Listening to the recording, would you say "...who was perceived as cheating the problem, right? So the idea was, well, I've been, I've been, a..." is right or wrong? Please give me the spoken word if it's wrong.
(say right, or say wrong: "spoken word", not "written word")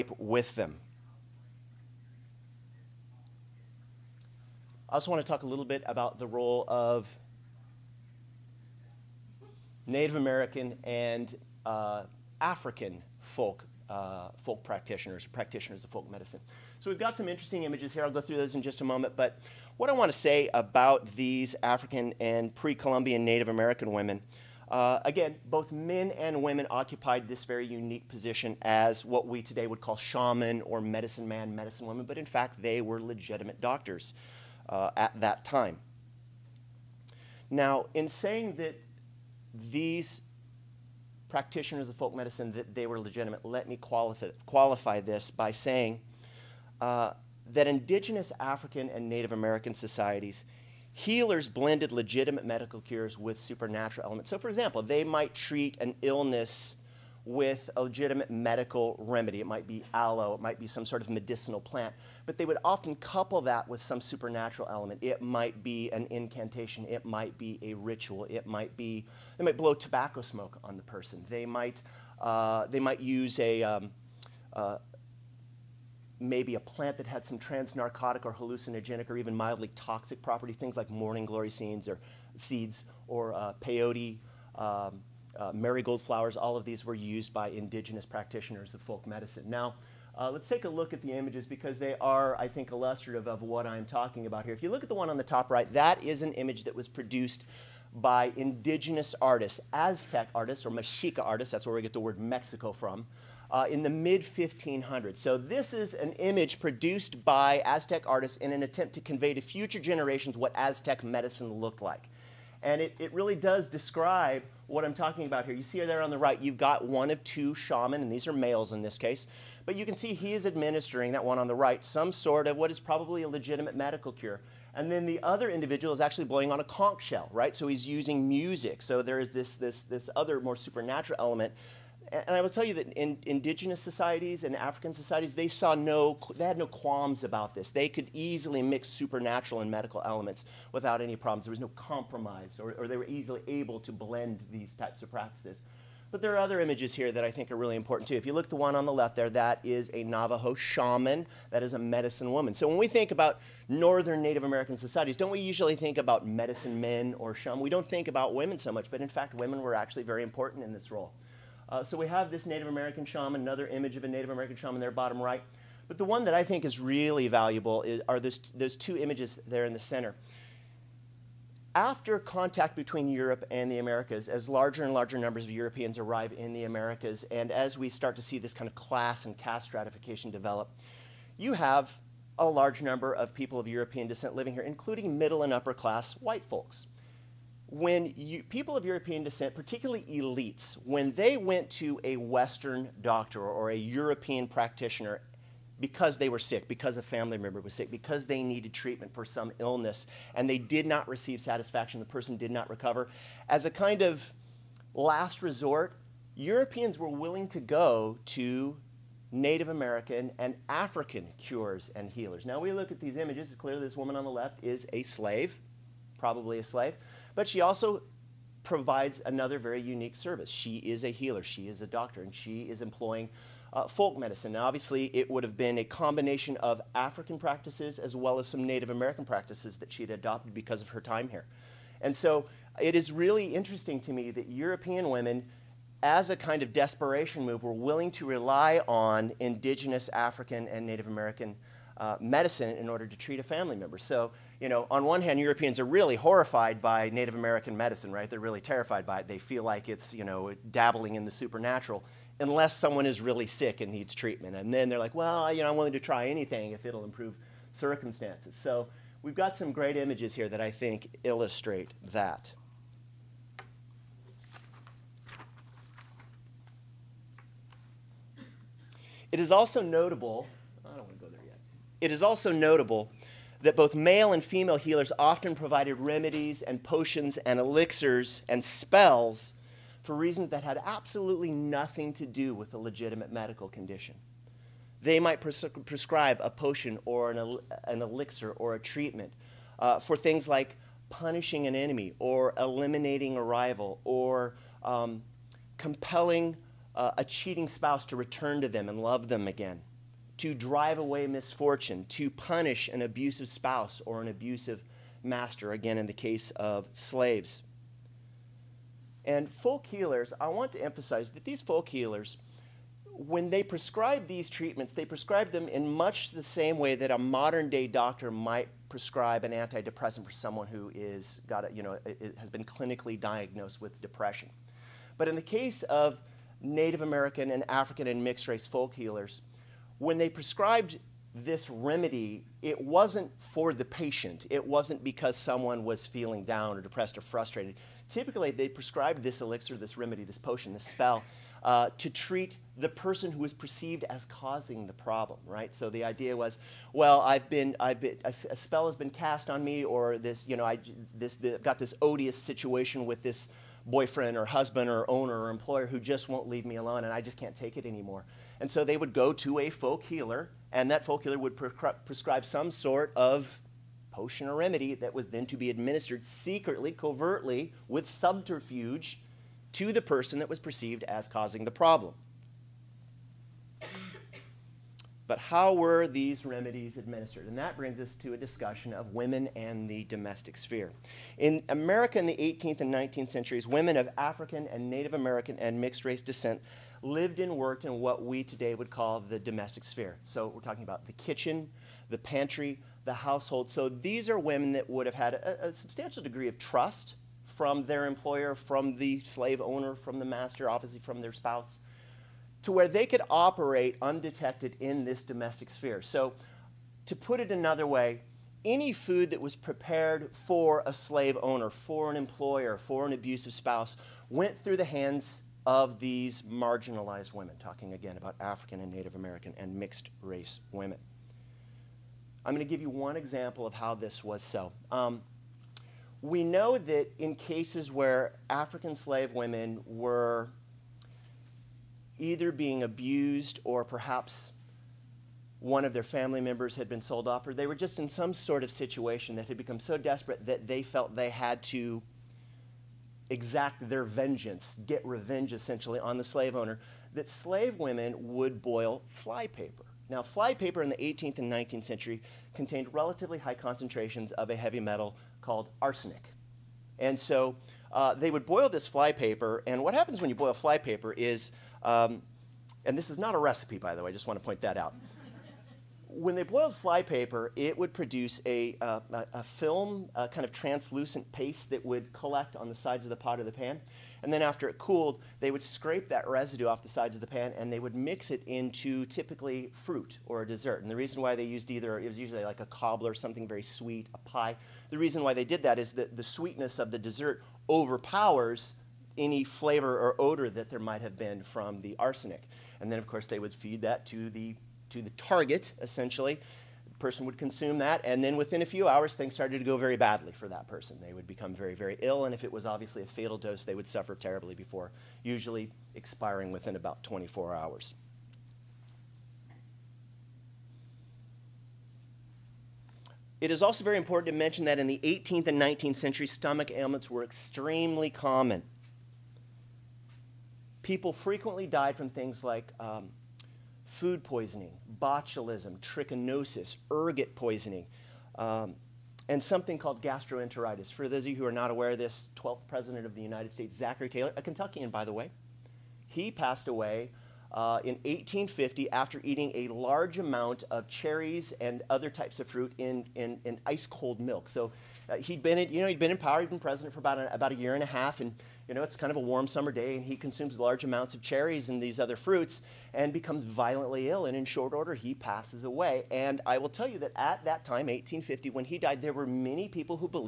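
wrong: "causing", not "cheating".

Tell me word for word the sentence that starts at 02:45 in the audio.
But the one that I think is really valuable is, are those, those two images there in the center.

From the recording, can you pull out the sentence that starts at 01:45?
So, this is an image produced by Aztec artists in an attempt to convey to future generations what Aztec medicine looked like.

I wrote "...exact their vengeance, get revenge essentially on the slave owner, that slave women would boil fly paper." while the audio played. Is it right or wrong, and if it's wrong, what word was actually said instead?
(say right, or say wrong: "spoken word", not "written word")
right.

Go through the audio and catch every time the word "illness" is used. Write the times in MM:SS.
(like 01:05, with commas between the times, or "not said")
00:56, 03:19.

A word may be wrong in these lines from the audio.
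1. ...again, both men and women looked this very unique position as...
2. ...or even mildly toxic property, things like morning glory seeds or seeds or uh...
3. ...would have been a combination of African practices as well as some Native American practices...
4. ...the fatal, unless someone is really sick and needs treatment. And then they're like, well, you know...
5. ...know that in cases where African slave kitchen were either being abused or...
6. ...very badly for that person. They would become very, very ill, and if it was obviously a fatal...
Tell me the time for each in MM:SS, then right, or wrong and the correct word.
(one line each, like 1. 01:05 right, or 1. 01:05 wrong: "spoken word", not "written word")
1. 00:25 wrong: "occupied", not "looked"
2. 01:19 right
3. 03:45 right
4. 04:11 wrong: "supernatural", not "fatal"
5. 07:06 wrong: "women", not "kitchen"
6. 08:19 right.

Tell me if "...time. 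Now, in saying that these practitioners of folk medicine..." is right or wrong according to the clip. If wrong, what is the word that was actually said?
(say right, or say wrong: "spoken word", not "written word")
right.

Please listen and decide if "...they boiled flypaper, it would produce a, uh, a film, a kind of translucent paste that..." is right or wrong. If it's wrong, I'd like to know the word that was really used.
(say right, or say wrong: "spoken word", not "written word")
right.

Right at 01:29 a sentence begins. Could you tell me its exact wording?
Now, uh, let's take a look at the images because they are, I think, illustrative of what I'm talking about here.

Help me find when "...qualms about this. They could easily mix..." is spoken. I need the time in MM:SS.
02:16.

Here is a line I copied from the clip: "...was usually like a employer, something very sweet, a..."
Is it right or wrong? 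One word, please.
wrong.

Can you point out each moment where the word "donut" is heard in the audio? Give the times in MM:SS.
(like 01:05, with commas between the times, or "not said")
not said.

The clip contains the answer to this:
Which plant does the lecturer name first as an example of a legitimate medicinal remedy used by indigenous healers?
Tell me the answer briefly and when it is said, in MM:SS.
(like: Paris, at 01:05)
aloe, at 00:59.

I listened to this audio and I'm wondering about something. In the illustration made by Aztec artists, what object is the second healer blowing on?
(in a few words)
conch shell.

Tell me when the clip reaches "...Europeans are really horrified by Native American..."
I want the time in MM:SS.
04:05.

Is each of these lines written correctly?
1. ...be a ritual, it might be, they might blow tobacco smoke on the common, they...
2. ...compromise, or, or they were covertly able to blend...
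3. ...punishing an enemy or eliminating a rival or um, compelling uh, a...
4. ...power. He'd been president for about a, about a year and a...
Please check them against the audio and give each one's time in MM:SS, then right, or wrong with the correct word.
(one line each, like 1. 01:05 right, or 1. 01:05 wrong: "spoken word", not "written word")
1. 01:07 wrong: "person", not "common"
2. 02:21 wrong: "easily", not "covertly"
3. 04:51 right
4. 09:06 right.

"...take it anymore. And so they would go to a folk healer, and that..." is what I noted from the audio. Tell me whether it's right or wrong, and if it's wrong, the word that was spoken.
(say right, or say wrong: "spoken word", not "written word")
right.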